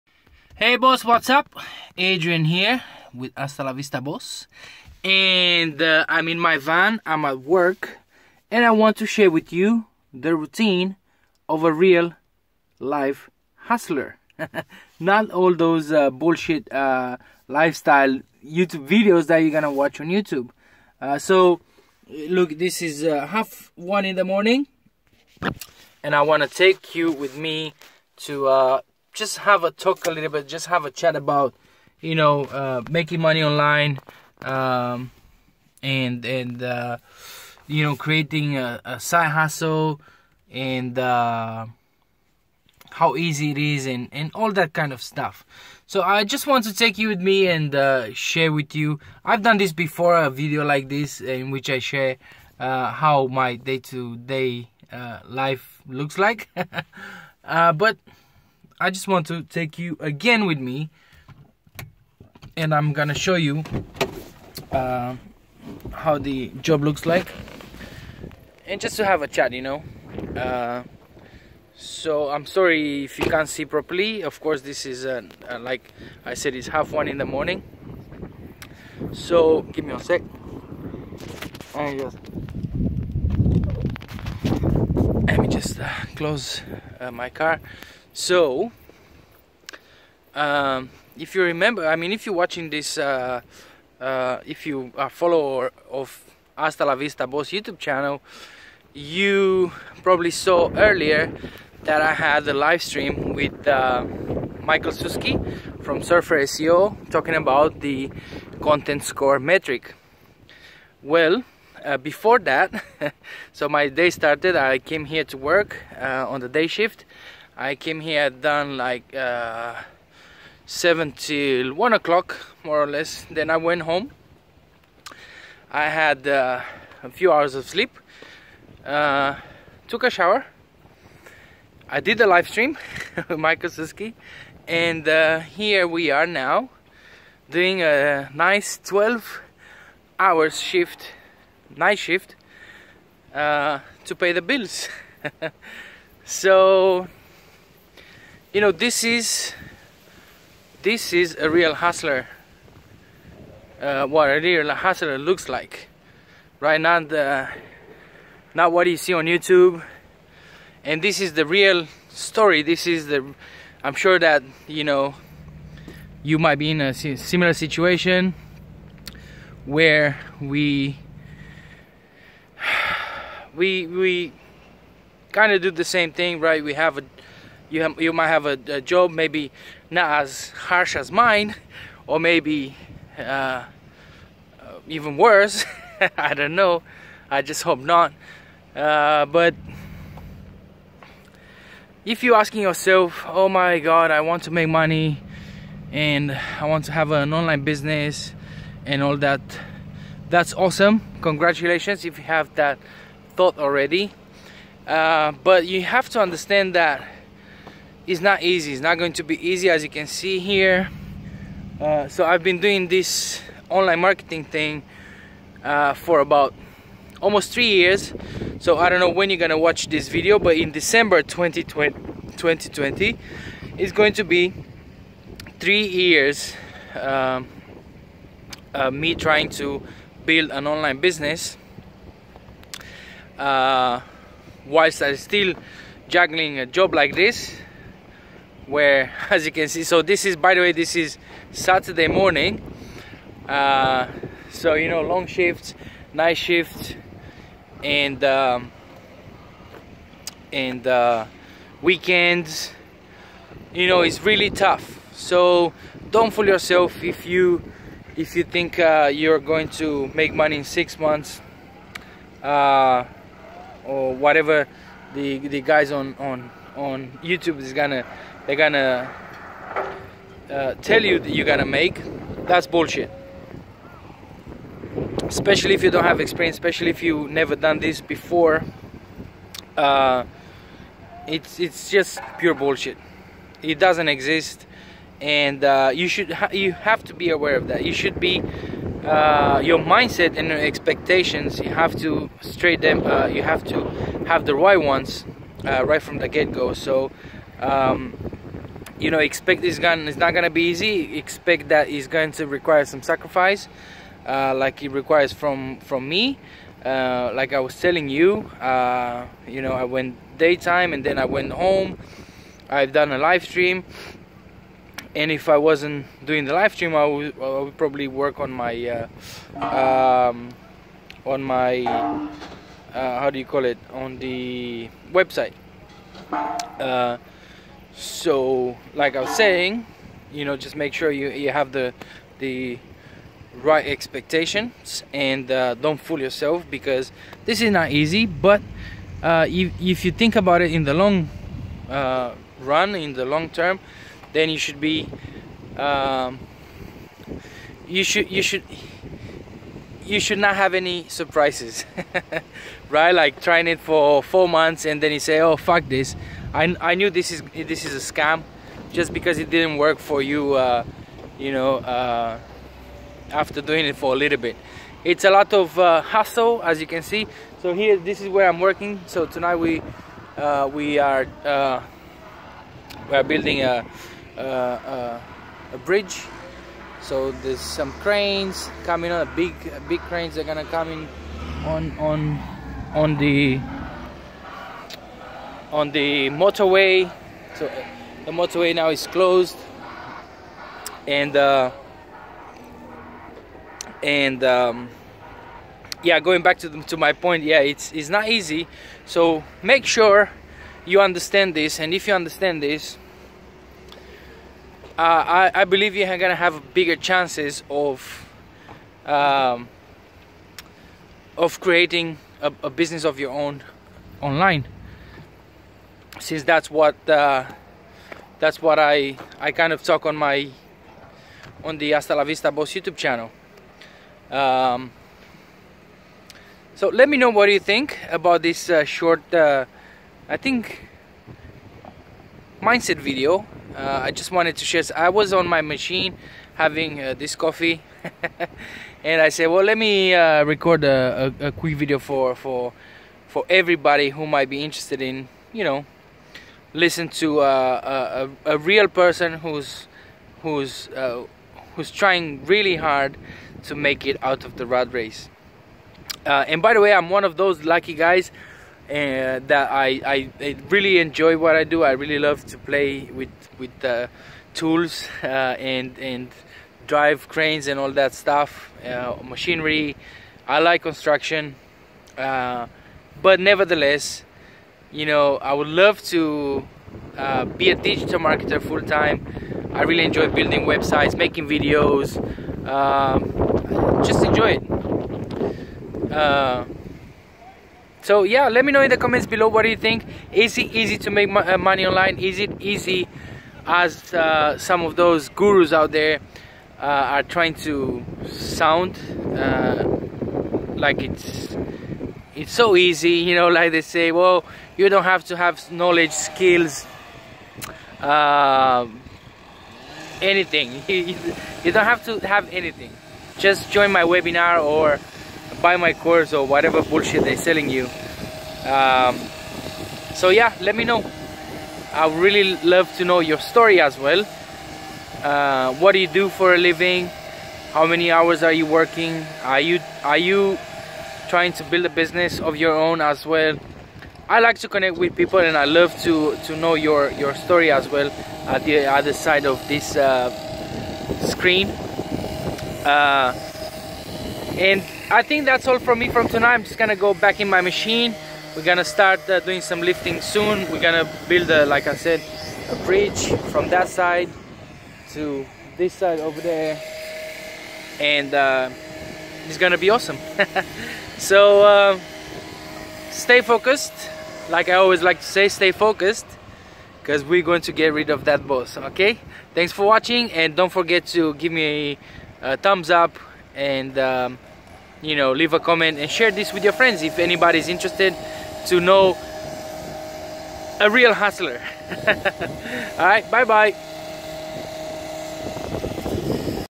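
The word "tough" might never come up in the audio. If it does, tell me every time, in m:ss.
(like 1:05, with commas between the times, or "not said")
4:14.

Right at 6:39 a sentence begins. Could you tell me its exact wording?
So make sure you understand this, and if you understand this, uh, I I believe you're gonna have bigger chances of.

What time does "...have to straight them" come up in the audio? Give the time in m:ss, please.
4:51.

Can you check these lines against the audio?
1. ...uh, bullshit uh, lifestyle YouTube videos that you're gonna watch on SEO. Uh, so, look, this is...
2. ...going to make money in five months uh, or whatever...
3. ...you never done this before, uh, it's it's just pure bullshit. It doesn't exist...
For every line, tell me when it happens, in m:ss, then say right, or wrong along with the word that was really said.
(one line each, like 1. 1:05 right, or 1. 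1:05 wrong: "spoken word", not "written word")
1. 0:15 wrong: "YouTube", not "SEO"
2. 4:19 wrong: "six", not "five"
3. 4:37 right.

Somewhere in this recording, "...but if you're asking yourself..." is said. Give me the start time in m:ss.
3:09.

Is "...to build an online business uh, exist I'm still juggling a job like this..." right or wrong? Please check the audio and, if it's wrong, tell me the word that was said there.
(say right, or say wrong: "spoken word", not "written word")
wrong: "whilst", not "exist".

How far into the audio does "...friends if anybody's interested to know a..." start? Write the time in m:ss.
9:36.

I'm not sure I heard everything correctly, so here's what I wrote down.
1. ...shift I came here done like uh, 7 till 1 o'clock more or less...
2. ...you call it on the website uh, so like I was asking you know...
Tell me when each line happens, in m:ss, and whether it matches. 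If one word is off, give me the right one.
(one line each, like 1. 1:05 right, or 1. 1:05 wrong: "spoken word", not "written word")
1. 1:56 right
2. 5:23 wrong: "saying", not "asking".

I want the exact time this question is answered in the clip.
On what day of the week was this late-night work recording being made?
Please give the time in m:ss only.
4:01.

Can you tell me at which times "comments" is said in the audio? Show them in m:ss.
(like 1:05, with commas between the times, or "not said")
8:08, 9:35.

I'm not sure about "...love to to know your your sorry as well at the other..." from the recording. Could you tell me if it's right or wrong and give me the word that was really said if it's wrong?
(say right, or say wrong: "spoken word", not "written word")
wrong: "story", not "sorry".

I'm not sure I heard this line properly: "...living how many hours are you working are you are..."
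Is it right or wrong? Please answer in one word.
right.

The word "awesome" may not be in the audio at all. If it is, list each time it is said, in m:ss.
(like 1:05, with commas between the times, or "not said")
3:20, 9:19.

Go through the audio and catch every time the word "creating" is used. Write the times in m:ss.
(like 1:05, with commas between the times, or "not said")
0:37, 6:51.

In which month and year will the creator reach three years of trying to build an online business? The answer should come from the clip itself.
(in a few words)
December 2020.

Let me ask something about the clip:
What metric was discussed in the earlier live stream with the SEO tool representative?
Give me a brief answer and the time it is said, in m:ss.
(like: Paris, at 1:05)
content score, at 1:48.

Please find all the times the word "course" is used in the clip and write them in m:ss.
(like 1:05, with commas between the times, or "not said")
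1:14, 8:35.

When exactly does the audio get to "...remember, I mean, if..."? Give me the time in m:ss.
1:31.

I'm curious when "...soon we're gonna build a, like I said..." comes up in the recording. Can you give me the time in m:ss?
9:10.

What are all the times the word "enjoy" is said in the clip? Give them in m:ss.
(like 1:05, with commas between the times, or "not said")
7:40, 8:00, 8:04.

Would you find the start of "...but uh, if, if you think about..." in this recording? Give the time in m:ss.
5:38.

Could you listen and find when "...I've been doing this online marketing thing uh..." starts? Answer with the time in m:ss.
3:32.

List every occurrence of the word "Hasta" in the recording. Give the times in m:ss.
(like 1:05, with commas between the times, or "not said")
0:03, 1:36, 7:01.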